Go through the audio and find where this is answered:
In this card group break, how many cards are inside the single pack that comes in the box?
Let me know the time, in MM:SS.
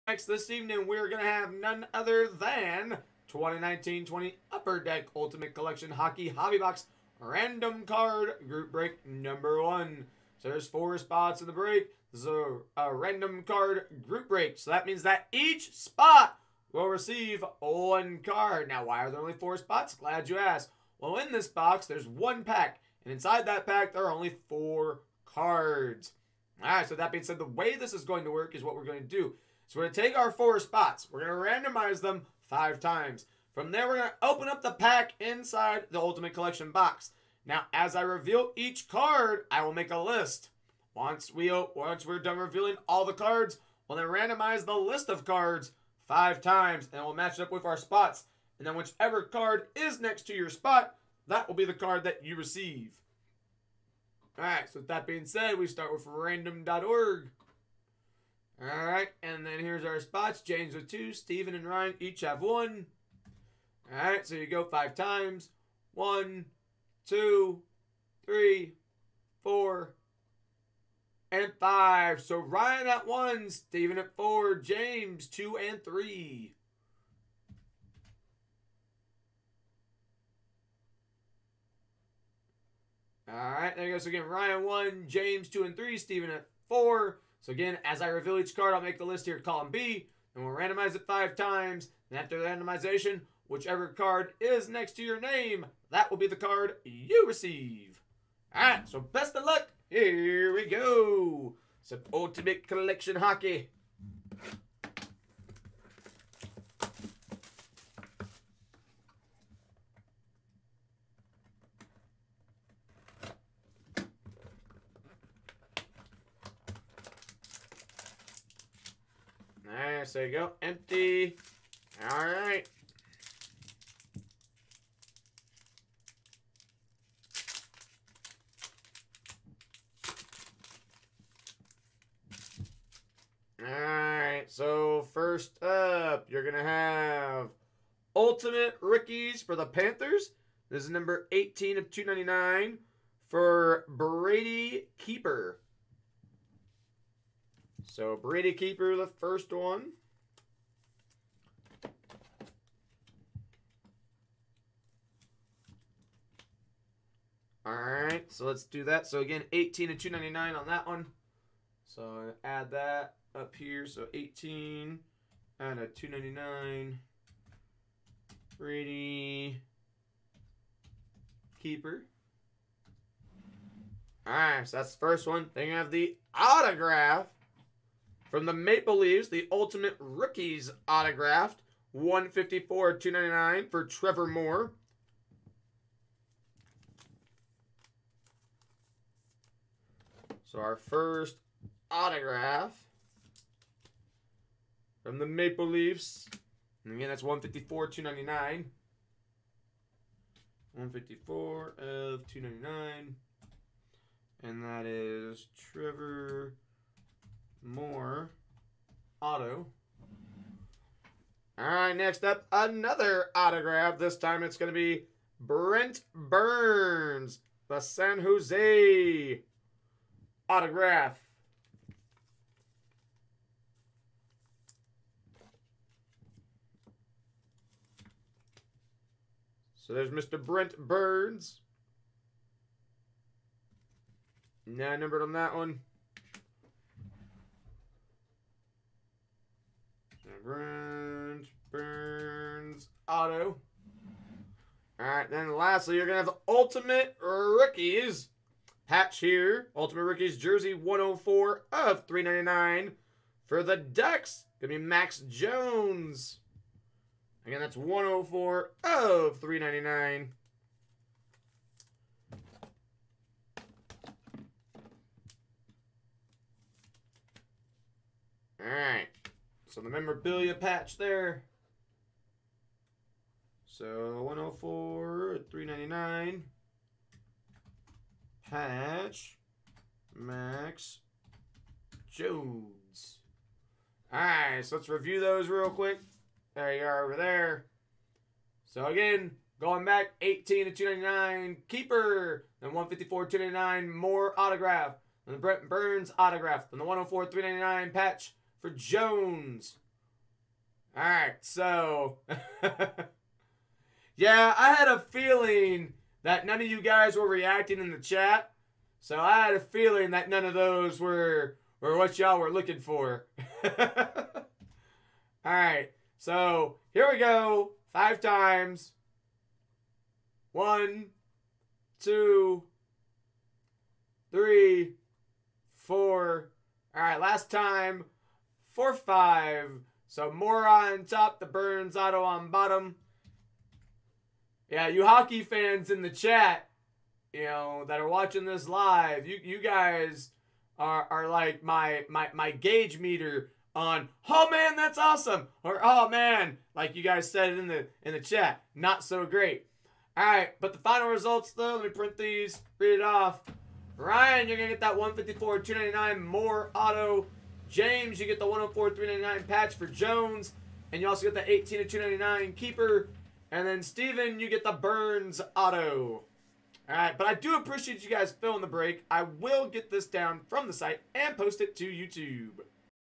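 00:24.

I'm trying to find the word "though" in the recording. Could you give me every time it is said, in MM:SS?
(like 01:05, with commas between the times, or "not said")
05:51.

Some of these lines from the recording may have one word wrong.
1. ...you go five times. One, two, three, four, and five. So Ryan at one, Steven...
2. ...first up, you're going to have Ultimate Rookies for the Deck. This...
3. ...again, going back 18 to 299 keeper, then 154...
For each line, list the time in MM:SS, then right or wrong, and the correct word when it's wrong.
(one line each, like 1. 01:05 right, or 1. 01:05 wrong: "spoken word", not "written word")
1. 01:04 right
2. 02:15 wrong: "Panthers", not "Deck"
3. 04:48 right.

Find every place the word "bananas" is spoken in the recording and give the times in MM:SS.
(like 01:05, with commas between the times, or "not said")
not said.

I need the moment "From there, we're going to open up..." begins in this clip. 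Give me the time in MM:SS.
00:33.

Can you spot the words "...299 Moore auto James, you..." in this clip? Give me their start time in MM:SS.
05:55.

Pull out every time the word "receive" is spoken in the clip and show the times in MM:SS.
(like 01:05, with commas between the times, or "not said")
00:16, 00:52, 01:37.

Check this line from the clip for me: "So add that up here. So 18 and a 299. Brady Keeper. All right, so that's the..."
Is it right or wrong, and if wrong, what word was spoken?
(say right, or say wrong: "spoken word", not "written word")
right.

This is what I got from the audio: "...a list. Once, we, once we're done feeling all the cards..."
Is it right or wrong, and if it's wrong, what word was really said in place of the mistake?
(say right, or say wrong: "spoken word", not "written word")
wrong: "revealing", not "feeling".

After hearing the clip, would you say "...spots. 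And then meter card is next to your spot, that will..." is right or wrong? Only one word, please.
wrong.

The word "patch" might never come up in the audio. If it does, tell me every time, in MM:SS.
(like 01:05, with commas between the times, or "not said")
04:08, 04:30, 04:38, 04:57, 05:59.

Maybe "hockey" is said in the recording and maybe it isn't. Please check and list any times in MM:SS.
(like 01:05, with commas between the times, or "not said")
00:05, 01:43, 05:35.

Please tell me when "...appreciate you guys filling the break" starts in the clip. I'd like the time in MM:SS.
06:07.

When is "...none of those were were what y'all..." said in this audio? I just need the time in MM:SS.
05:10.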